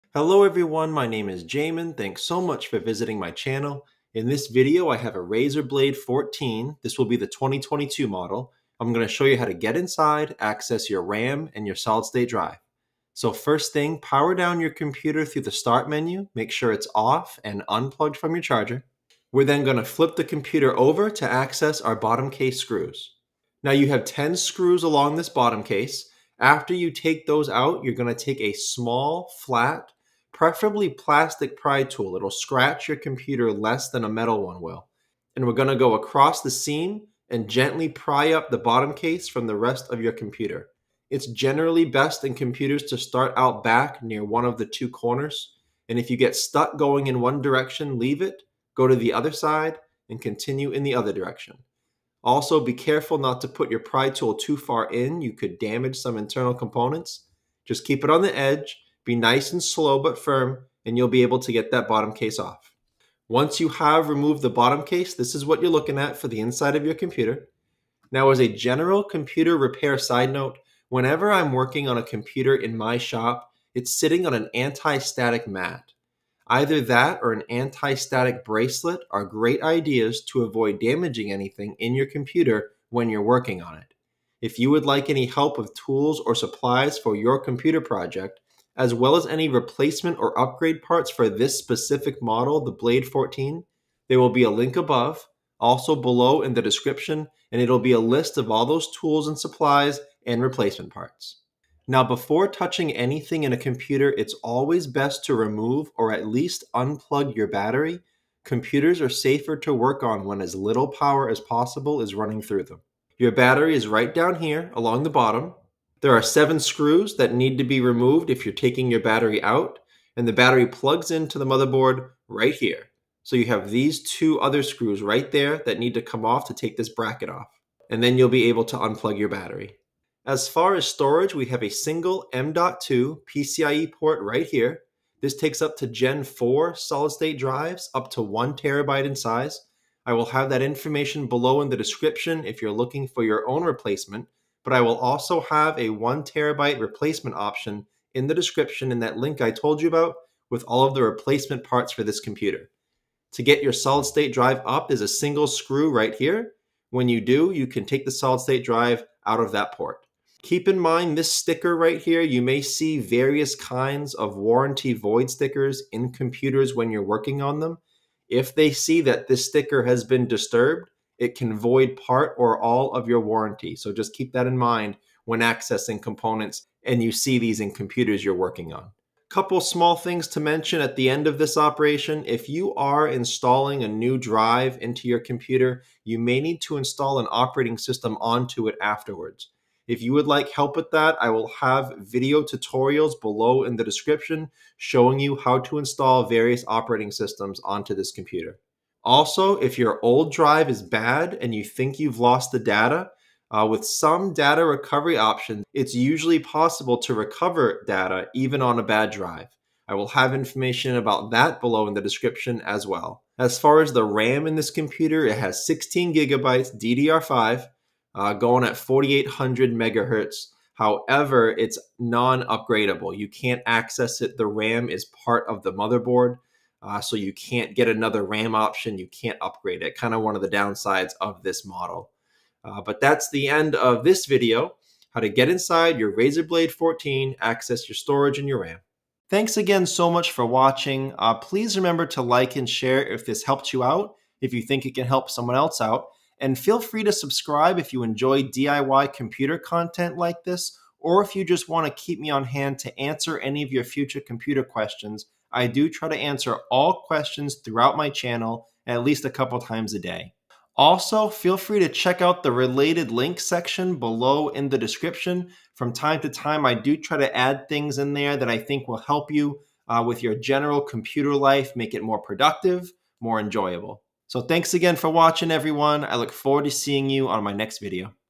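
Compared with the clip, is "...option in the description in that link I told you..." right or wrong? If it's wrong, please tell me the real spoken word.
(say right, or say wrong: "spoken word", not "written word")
right.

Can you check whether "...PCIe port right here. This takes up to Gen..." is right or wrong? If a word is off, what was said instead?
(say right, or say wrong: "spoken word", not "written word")
right.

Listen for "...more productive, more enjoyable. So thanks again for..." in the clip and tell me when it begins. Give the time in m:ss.
4:32.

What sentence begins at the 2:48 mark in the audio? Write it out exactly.
If they see that this sticker has been disturbed, it can void part or all of your warranty.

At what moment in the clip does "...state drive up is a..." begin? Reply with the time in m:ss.
2:34.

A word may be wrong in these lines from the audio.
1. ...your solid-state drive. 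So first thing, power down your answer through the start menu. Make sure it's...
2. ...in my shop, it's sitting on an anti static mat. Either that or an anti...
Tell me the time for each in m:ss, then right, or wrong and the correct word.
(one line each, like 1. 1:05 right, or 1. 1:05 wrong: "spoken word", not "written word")
1. 0:11 wrong: "computer", not "answer"
2. 1:12 right.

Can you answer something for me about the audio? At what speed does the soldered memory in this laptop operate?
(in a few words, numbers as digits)
4800 megahertz.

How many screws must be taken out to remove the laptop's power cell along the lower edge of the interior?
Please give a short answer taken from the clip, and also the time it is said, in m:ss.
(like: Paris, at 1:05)
7, at 1:56.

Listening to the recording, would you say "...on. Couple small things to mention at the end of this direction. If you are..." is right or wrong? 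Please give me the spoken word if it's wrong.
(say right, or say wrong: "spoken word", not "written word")
wrong: "operation", not "direction".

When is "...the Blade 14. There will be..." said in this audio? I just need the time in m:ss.
1:32.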